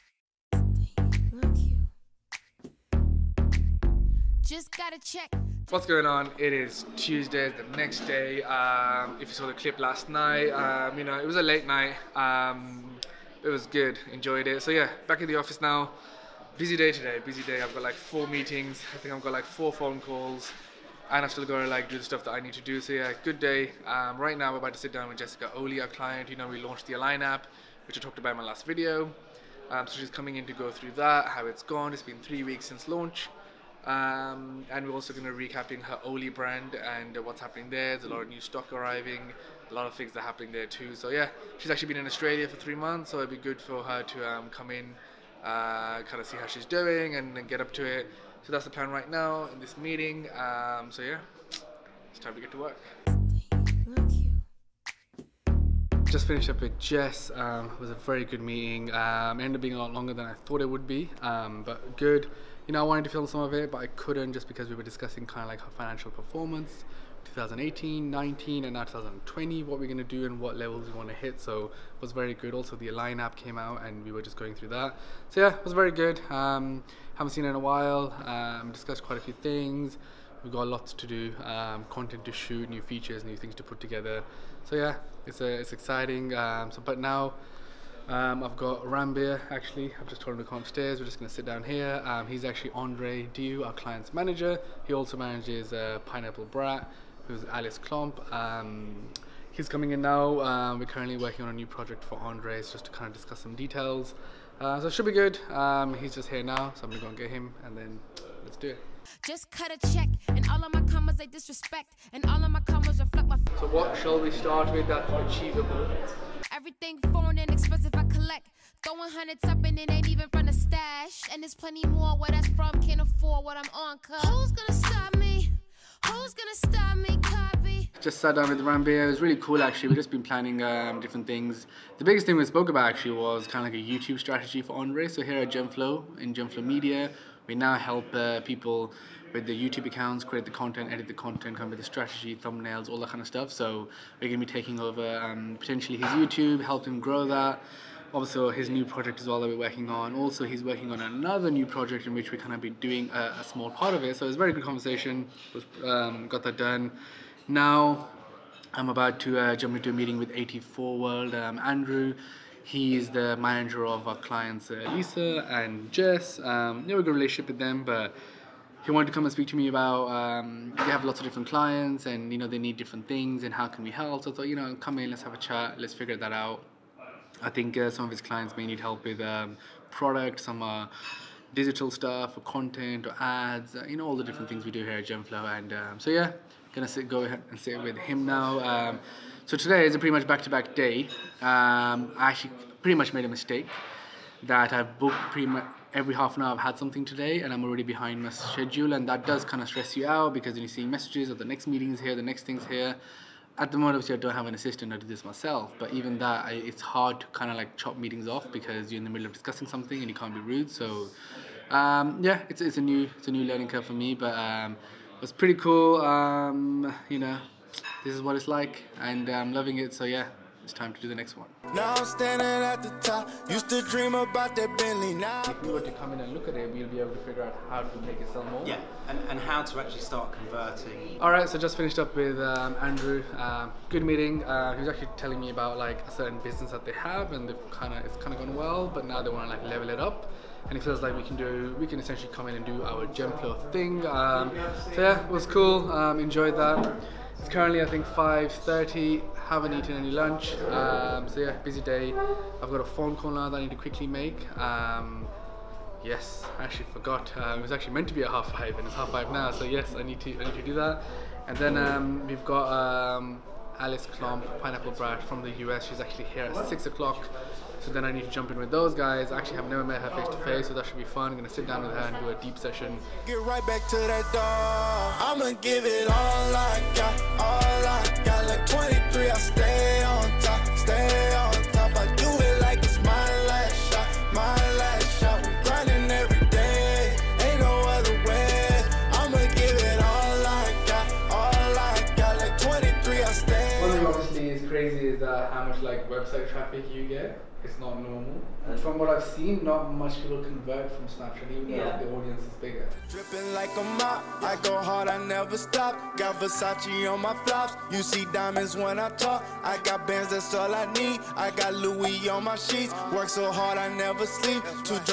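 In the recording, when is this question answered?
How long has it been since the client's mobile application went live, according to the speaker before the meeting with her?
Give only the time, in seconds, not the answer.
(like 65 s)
32 s.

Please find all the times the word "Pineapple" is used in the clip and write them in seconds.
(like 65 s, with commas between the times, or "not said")
96 s, 264 s.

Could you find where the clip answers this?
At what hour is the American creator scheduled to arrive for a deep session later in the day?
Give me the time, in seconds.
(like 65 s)
266 s.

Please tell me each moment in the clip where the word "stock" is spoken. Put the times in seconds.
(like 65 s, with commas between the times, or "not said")
38 s.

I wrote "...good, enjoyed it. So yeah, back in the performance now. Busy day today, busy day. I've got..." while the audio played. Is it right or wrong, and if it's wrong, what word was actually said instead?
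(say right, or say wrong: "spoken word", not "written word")
wrong: "office", not "performance".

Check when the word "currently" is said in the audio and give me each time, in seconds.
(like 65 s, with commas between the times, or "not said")
100 s, 247 s.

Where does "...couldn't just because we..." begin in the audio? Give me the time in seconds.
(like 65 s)
63 s.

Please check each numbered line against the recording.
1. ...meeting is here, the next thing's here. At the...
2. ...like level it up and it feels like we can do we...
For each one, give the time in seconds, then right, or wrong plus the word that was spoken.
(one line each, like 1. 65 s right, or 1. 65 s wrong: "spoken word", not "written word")
1. 201 s right
2. 239 s right.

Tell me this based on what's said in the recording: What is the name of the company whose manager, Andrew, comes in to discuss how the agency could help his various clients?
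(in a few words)
84 World.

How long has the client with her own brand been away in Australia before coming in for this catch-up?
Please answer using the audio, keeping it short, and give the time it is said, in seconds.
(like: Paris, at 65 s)
3 months, at 42 s.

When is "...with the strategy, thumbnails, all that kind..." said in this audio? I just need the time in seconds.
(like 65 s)
141 s.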